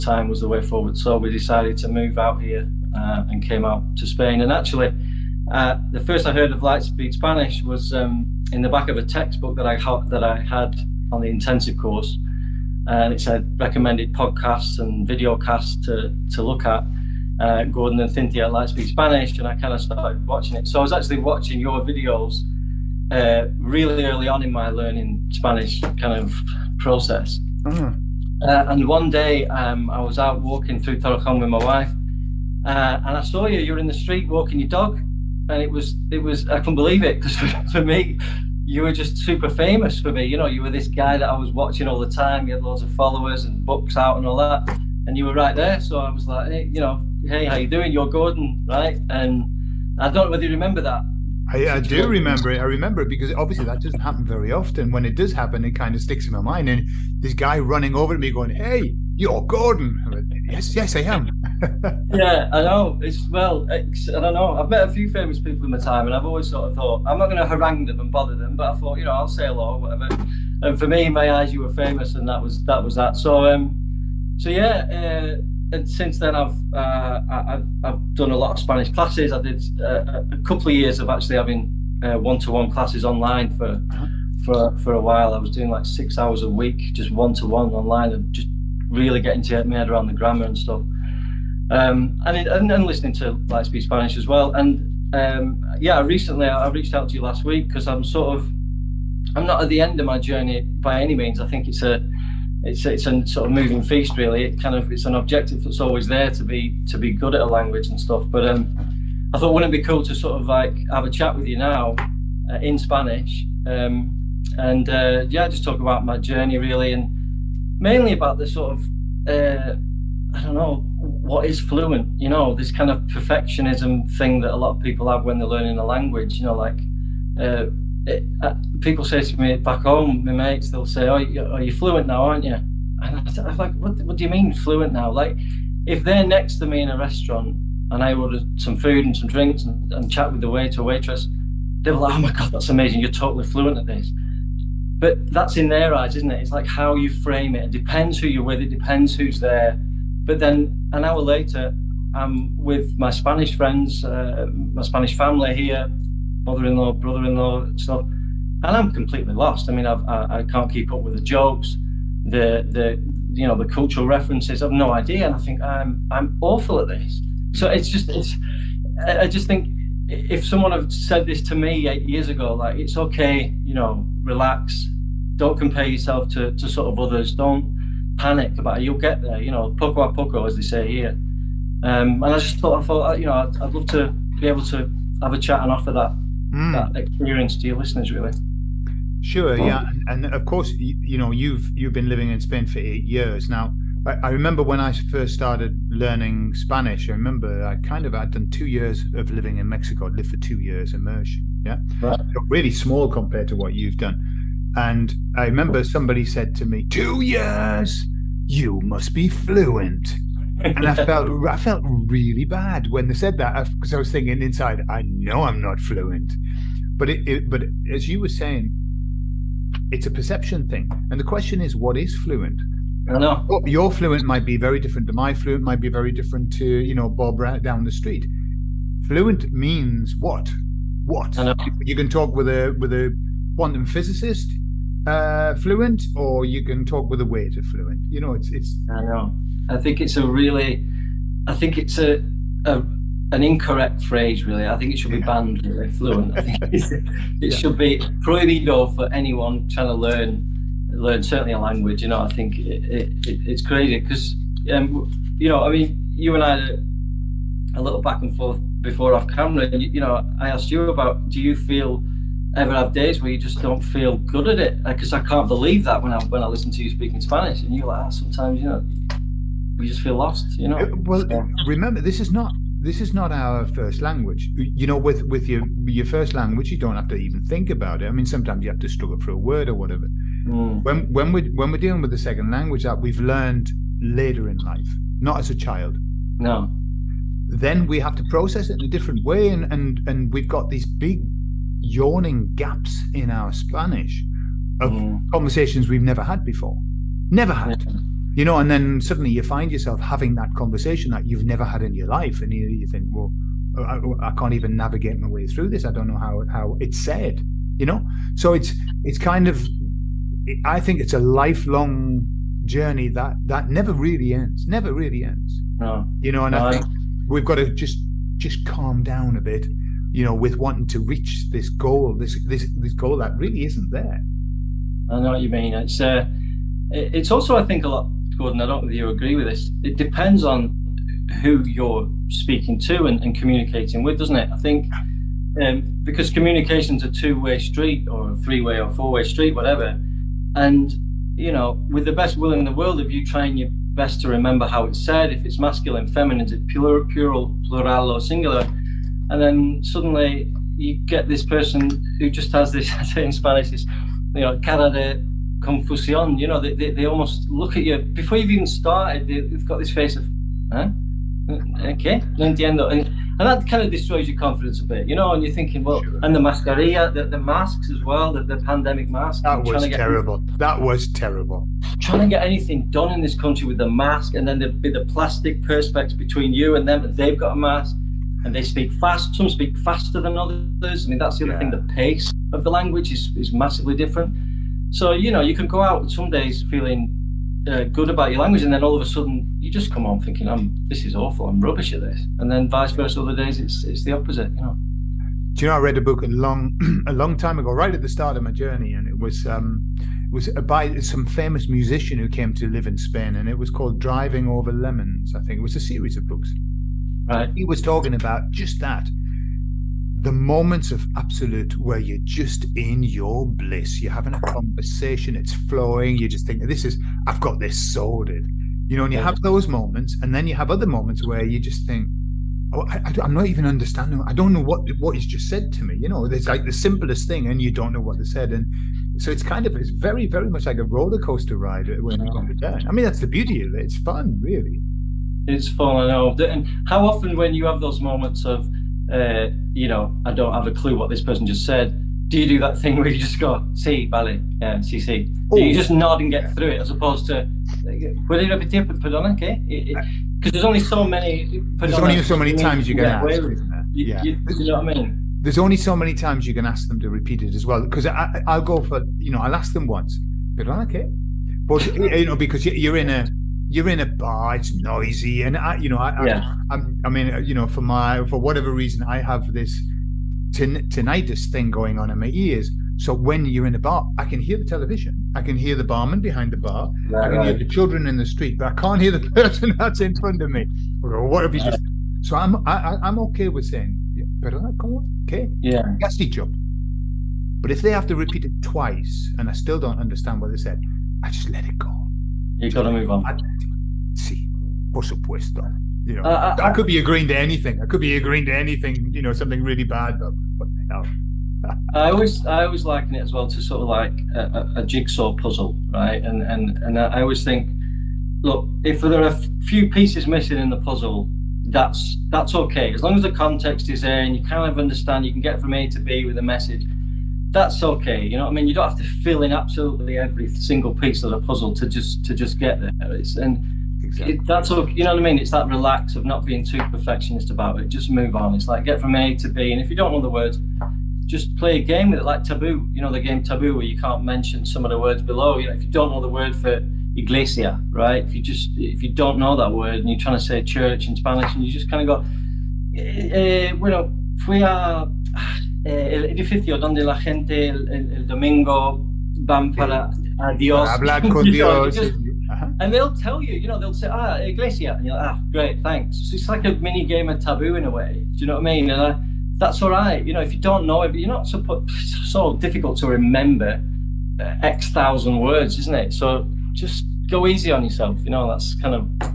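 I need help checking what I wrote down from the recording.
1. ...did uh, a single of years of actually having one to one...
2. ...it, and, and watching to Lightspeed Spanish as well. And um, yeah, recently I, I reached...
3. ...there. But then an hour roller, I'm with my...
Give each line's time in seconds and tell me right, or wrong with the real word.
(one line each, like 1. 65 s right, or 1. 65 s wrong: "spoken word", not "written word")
1. 79 s wrong: "couple", not "single"
2. 92 s wrong: "listening", not "watching"
3. 149 s wrong: "later", not "roller".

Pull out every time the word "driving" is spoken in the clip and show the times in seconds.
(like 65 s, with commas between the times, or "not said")
404 s.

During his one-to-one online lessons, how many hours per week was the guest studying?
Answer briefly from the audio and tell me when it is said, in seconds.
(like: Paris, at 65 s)
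6, at 85 s.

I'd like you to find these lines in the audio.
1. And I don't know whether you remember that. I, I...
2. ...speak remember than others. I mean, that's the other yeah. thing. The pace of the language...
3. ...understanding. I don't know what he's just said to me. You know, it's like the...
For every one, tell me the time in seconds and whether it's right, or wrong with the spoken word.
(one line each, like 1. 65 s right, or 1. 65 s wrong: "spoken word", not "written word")
1. 49 s right
2. 379 s wrong: "faster", not "remember"
3. 423 s right.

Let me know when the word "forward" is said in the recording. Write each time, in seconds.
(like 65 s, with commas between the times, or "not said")
0 s.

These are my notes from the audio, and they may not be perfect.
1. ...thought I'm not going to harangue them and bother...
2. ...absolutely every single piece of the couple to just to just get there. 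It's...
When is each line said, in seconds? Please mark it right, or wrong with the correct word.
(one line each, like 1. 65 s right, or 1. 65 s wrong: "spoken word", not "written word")
1. 66 s right
2. 519 s wrong: "puzzle", not "couple".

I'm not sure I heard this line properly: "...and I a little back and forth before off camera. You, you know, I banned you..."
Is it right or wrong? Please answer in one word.
wrong.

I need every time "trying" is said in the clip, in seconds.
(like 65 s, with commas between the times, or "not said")
249 s, 343 s, 371 s, 540 s.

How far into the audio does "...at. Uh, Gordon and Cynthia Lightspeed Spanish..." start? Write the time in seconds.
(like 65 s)
16 s.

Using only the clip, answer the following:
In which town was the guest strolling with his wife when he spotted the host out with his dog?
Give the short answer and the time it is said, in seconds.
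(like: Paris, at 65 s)
Torrejon, at 30 s.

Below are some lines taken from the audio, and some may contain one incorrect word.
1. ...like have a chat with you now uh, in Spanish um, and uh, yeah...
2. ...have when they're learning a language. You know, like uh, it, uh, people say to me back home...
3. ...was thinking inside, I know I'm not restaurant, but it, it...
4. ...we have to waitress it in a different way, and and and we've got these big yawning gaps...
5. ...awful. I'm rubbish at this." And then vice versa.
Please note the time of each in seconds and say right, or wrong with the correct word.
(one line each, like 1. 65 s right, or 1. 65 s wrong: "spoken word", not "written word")
1. 110 s right
2. 125 s right
3. 213 s wrong: "fluent", not "restaurant"
4. 287 s wrong: "process", not "waitress"
5. 391 s right.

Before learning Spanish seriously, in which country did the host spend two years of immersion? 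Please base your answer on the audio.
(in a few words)
Mexico.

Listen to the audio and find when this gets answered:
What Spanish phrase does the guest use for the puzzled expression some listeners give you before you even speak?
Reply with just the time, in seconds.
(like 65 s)
354 s.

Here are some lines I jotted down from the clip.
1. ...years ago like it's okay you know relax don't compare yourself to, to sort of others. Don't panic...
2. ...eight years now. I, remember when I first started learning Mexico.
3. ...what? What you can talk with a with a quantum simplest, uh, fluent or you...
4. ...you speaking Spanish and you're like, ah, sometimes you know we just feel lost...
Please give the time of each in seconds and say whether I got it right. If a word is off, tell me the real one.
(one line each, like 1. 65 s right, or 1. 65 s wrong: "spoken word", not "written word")
1. 172 s right
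2. 192 s wrong: "Spanish", not "Mexico"
3. 230 s wrong: "physicist", not "simplest"
4. 266 s right.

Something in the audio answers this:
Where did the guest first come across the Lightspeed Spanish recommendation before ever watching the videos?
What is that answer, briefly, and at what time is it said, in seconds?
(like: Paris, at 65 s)
Back of a textbook, at 8 s.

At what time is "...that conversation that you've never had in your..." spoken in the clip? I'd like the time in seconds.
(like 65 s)
300 s.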